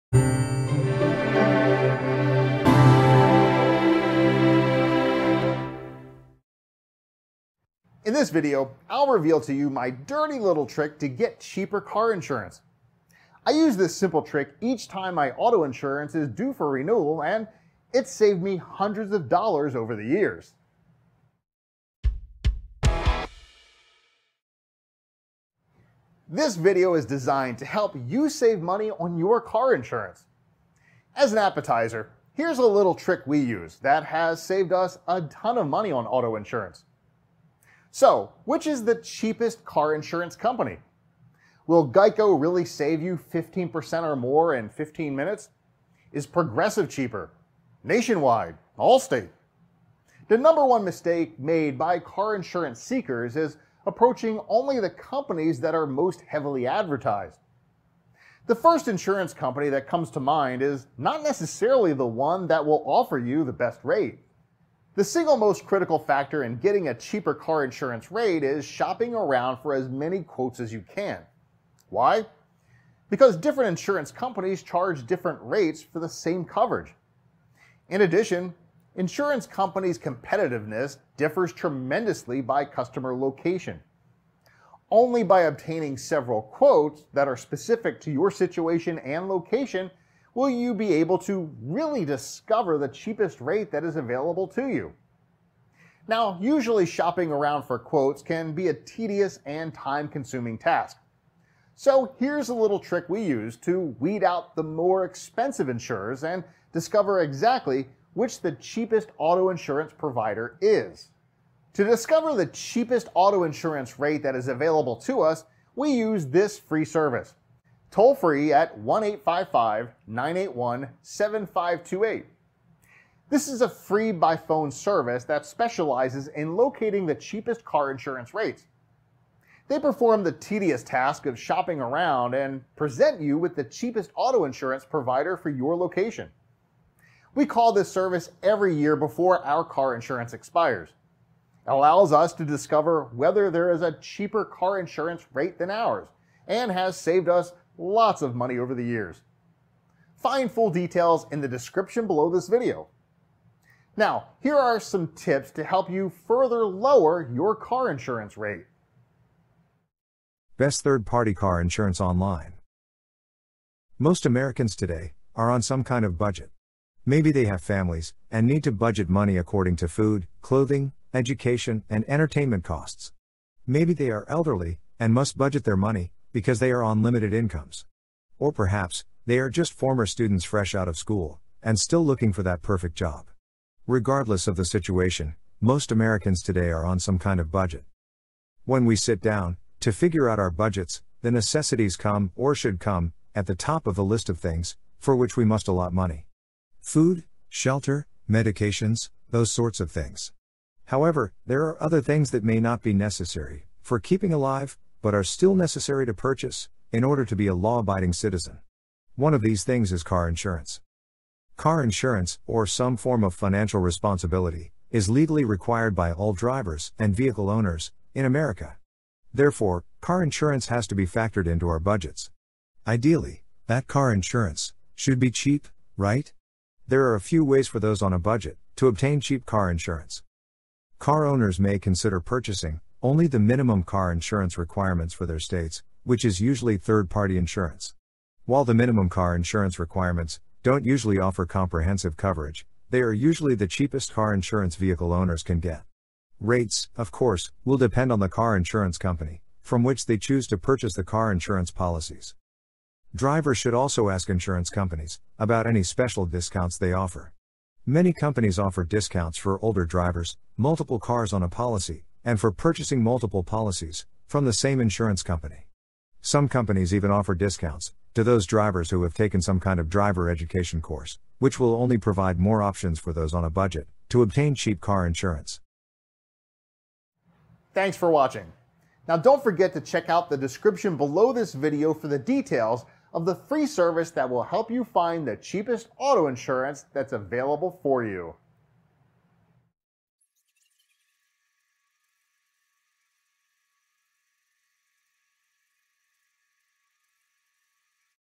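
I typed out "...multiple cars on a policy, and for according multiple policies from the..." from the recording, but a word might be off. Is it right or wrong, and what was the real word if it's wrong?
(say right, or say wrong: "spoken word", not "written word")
wrong: "purchasing", not "according".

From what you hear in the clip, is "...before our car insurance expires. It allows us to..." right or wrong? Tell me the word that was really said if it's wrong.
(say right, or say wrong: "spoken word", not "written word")
right.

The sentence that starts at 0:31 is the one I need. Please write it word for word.
As an appetizer, here's a little trick we use that has saved us a ton of money on auto insurance.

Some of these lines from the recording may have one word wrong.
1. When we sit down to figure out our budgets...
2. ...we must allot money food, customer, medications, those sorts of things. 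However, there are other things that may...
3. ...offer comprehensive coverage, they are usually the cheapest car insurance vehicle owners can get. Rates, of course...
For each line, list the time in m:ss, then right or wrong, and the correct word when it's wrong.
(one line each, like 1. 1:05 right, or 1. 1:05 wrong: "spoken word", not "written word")
1. 3:08 right
2. 3:15 wrong: "shelter", not "customer"
3. 4:01 right.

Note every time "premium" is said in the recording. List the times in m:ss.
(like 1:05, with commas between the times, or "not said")
not said.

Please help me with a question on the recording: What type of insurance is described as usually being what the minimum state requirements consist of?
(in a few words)
third party insurance.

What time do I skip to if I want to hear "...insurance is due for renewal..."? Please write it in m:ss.
0:15.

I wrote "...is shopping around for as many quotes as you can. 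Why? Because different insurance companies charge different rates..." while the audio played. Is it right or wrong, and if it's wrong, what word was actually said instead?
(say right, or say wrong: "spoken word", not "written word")
right.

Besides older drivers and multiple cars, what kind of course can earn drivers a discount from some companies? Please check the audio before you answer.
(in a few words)
driver education course.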